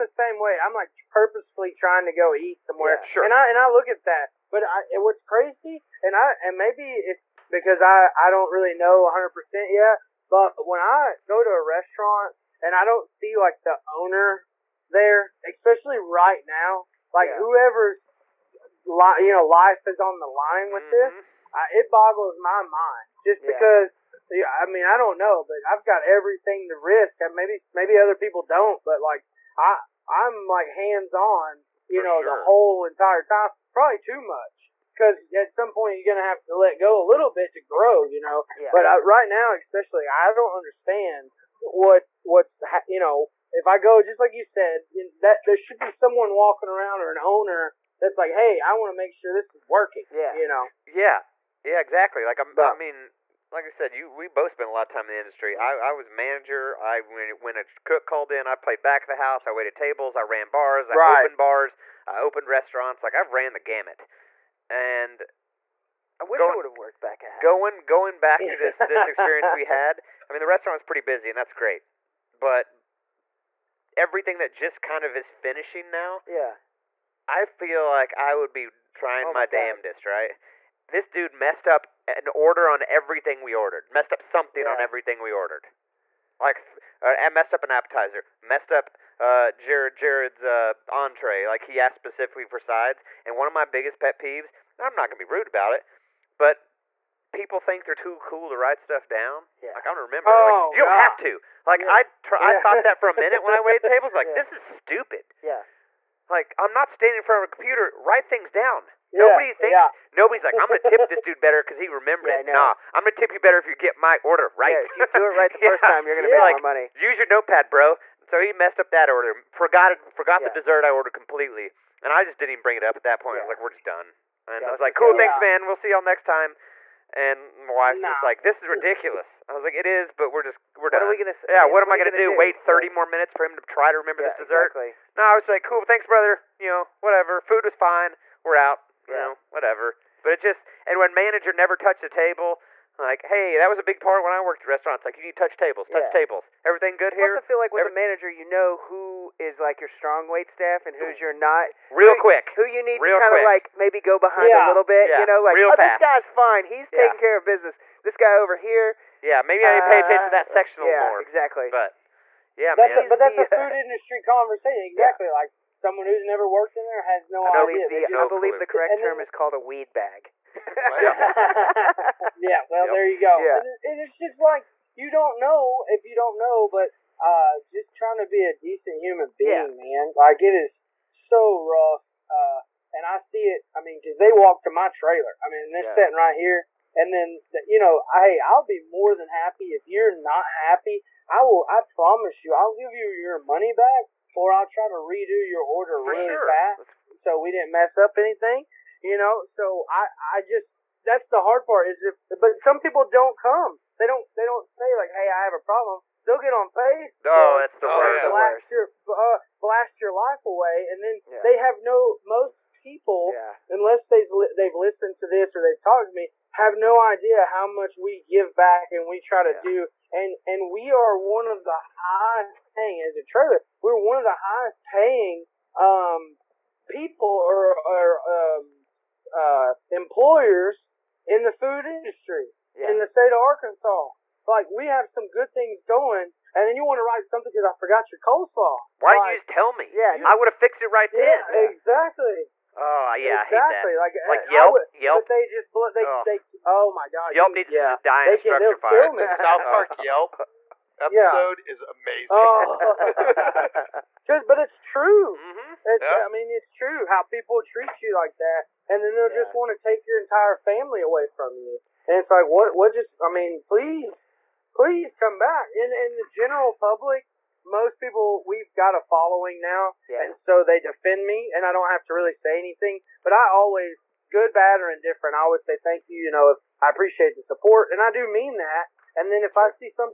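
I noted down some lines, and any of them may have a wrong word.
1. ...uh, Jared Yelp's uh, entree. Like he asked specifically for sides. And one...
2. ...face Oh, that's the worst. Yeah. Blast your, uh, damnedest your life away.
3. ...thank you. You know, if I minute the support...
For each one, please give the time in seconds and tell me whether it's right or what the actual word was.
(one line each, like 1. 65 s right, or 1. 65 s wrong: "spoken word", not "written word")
1. 89 s wrong: "Jared", not "Yelp"
2. 206 s wrong: "blast", not "damnedest"
3. 275 s wrong: "appreciate", not "minute".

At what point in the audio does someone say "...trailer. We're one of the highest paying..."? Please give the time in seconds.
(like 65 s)
223 s.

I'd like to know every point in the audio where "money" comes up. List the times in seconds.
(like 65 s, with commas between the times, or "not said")
116 s, 193 s.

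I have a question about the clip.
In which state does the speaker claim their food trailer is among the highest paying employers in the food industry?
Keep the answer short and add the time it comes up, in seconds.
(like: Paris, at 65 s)
Arkansas, at 233 s.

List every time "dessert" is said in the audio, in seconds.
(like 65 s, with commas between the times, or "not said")
120 s, 134 s.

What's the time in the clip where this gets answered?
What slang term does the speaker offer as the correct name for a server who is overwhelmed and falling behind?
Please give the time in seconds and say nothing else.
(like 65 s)
169 s.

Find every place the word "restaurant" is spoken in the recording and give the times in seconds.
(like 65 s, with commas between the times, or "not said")
11 s, 62 s, 70 s, 144 s.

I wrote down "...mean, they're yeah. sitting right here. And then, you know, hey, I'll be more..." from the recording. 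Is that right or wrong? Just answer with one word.
right.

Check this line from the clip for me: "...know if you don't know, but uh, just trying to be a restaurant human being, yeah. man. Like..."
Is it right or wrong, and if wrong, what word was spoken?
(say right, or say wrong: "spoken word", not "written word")
wrong: "decent", not "restaurant".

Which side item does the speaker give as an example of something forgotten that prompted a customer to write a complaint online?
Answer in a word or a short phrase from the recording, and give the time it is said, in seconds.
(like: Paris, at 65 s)
coleslaw, at 238 s.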